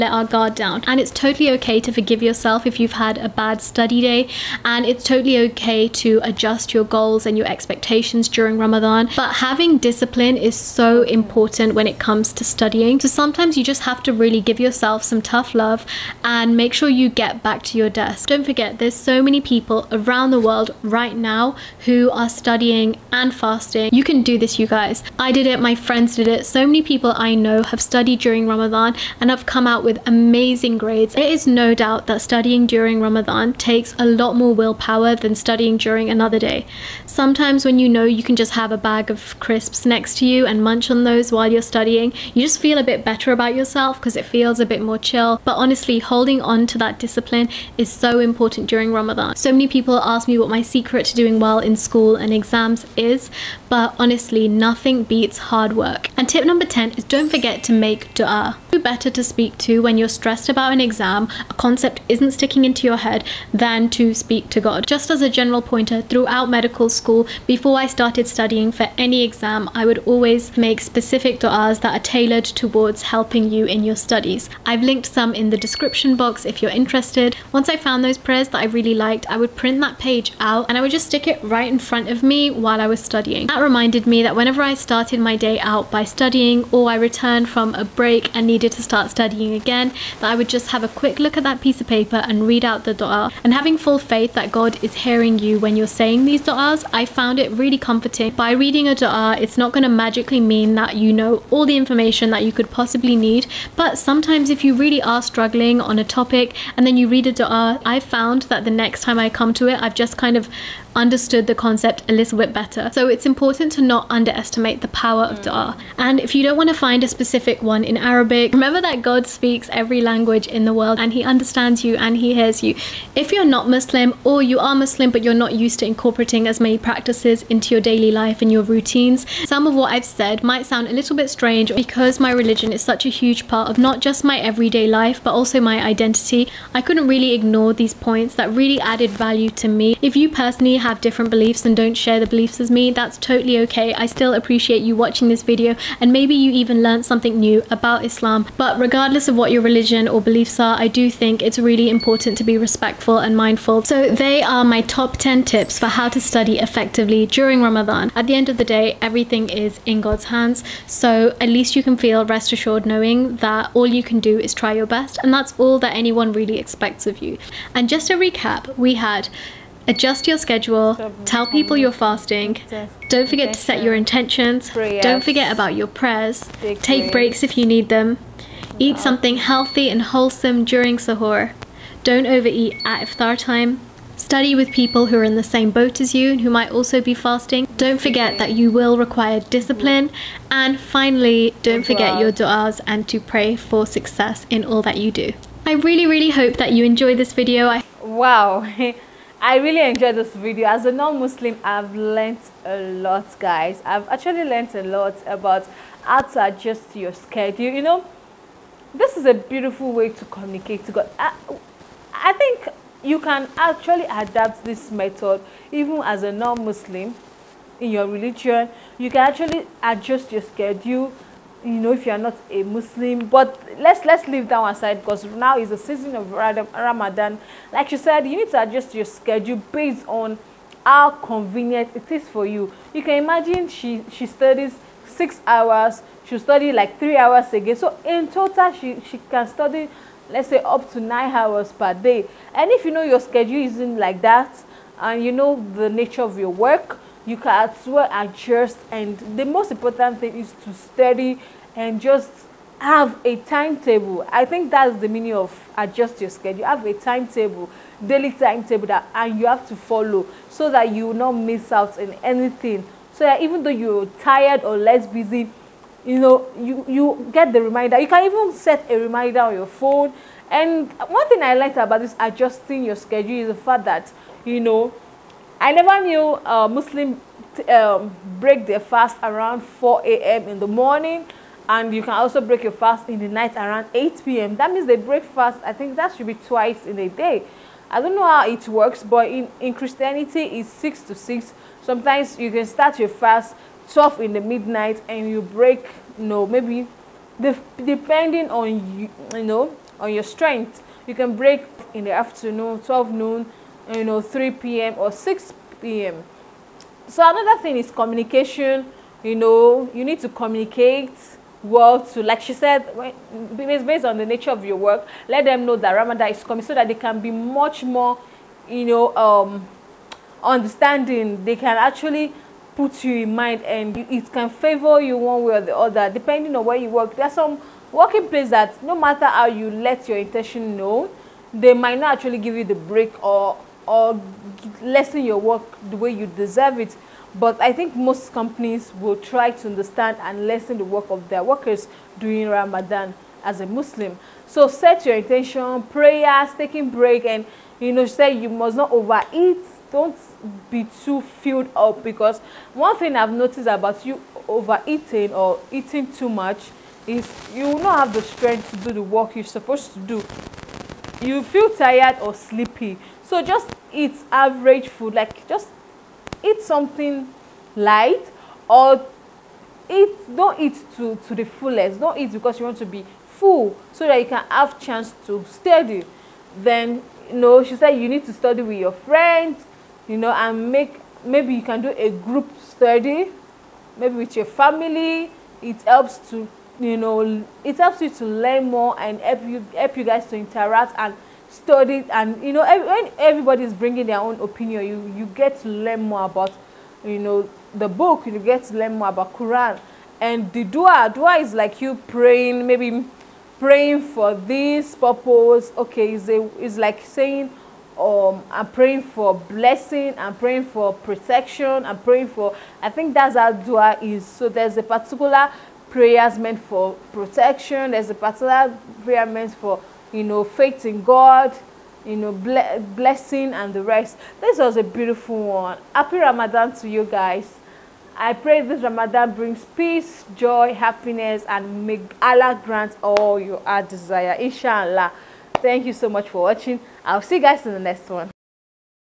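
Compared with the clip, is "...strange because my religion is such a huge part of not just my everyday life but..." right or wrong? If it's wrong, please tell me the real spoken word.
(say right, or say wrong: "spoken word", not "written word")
right.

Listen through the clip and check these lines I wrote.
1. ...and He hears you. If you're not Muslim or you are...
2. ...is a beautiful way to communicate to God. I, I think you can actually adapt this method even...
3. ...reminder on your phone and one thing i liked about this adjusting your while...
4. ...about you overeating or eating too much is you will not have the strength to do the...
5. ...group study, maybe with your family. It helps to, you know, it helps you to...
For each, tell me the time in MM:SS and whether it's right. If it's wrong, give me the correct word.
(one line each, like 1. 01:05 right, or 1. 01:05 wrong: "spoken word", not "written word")
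1. 02:01 right
2. 03:29 right
3. 04:28 wrong: "schedule", not "while"
4. 05:53 right
5. 06:22 right.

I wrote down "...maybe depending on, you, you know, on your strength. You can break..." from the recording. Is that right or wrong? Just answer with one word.
right.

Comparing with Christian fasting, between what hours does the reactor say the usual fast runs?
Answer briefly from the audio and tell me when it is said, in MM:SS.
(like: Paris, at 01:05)
6 to 6, at 04:50.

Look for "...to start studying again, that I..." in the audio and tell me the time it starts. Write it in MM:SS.
01:28.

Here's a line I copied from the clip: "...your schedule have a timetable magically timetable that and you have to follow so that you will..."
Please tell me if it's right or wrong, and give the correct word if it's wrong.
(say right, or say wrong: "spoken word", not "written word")
wrong: "daily", not "magically".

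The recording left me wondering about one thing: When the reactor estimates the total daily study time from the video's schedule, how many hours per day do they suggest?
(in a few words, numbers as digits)
9.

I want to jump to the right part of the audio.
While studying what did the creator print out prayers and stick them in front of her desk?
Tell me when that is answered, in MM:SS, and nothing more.
01:06.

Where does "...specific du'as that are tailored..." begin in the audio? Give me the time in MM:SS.
01:10.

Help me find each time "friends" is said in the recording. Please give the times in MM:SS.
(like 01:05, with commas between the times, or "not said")
00:25, 06:18.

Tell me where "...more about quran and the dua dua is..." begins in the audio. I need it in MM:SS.
06:38.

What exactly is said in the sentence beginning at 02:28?
But regardless of what your religion or beliefs are, I do think it's really important to be respectful and mindful.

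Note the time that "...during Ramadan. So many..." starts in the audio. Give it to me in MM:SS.
00:48.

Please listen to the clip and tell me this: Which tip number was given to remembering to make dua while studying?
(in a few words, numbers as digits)
10.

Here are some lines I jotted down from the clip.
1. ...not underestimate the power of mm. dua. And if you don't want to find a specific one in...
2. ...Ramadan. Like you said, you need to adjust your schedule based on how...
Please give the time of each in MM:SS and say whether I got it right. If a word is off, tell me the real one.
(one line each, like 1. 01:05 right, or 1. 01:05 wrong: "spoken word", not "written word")
1. 01:53 right
2. 03:46 right.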